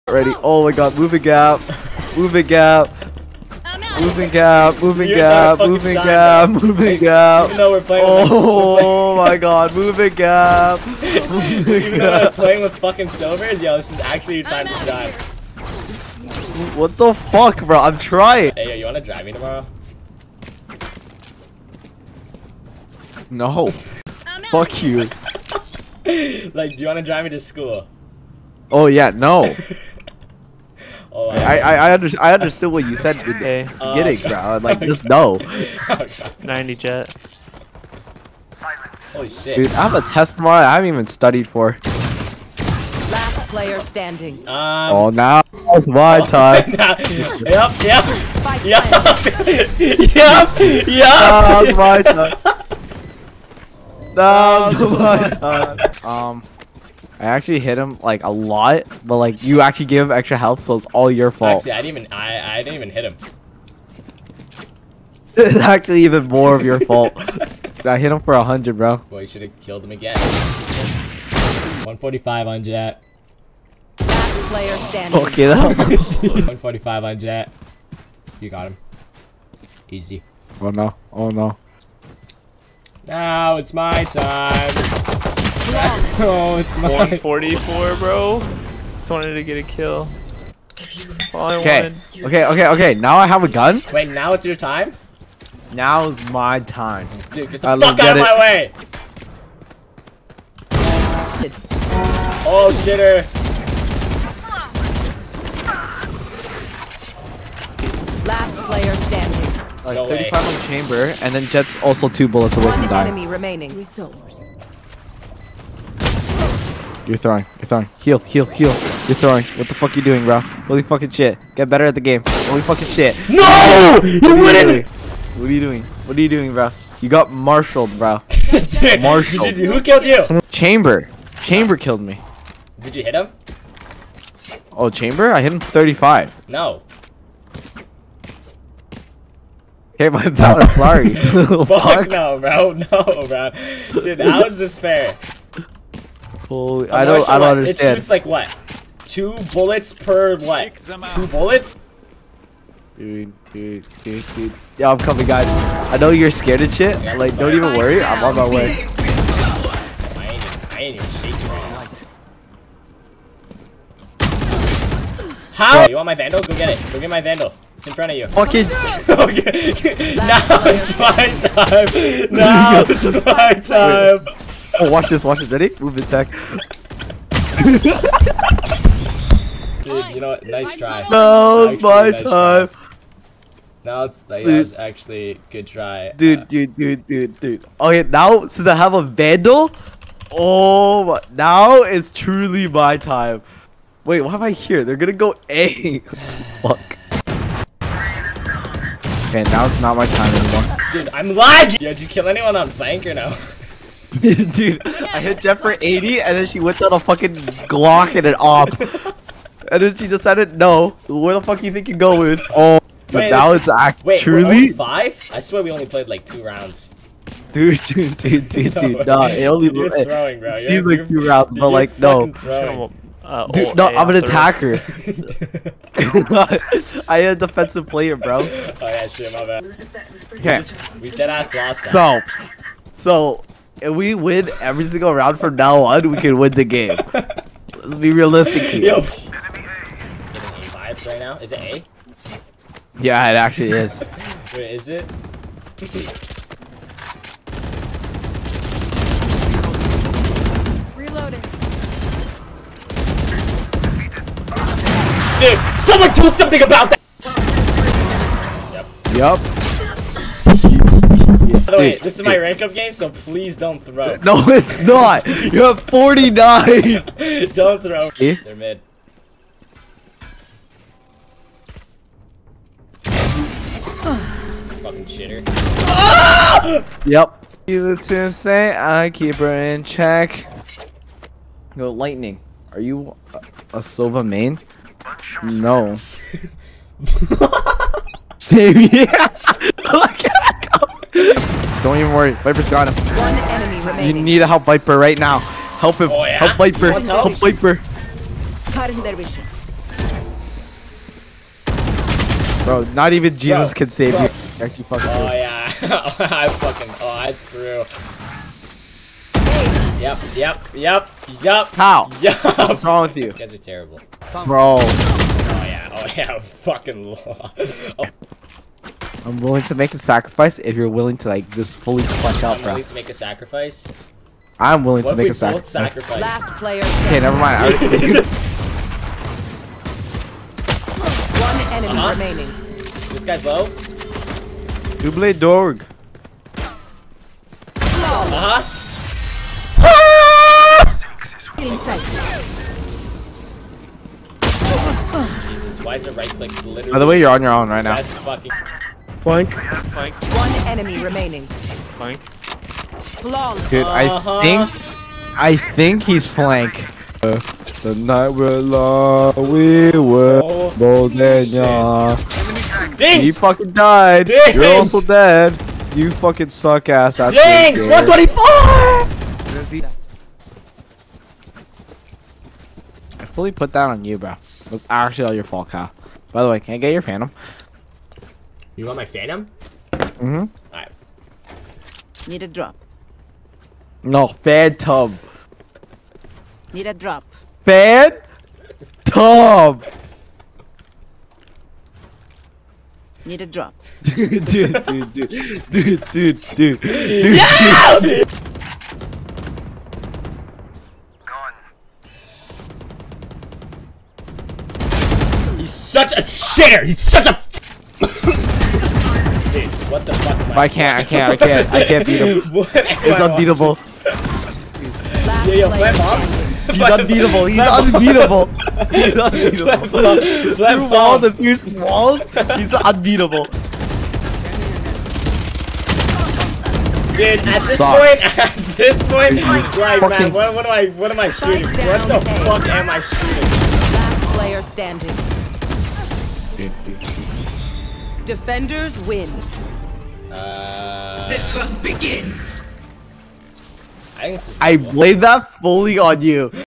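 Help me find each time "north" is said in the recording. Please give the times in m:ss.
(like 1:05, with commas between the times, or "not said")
not said.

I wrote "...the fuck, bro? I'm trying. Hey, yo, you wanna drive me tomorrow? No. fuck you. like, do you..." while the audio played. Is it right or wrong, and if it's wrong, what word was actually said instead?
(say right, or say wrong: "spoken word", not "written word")
right.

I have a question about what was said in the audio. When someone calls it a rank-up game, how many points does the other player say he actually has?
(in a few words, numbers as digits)
49.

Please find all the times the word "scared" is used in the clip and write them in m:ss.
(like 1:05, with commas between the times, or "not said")
2:36.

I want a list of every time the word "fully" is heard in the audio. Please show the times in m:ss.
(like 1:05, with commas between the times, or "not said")
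5:21, 6:13, 7:25.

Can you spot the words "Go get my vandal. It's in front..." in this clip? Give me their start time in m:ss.
2:46.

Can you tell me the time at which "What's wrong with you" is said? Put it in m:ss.
5:12.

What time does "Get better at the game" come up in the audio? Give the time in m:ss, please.
2:01.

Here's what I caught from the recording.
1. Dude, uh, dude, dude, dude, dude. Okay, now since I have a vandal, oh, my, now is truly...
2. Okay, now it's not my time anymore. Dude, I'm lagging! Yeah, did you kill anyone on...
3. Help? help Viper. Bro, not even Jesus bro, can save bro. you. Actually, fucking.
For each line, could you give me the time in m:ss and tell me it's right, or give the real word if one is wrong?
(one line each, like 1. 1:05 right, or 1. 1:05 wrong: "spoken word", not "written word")
1. 3:06 right
2. 3:19 right
3. 4:56 right.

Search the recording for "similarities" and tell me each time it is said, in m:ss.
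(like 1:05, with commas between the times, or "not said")
not said.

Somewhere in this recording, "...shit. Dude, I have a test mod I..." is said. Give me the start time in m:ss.
0:39.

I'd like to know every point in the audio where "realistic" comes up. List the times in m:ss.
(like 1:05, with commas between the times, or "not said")
3:58.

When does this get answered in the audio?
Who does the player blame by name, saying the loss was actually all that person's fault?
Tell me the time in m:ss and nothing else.
6:14.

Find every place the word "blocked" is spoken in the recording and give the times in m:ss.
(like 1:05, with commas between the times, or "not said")
not said.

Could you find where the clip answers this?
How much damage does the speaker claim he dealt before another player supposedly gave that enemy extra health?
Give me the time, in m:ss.
1:07.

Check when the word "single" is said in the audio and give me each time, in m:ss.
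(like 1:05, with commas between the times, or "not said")
3:54.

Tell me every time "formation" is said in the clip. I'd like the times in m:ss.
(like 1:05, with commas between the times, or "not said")
not said.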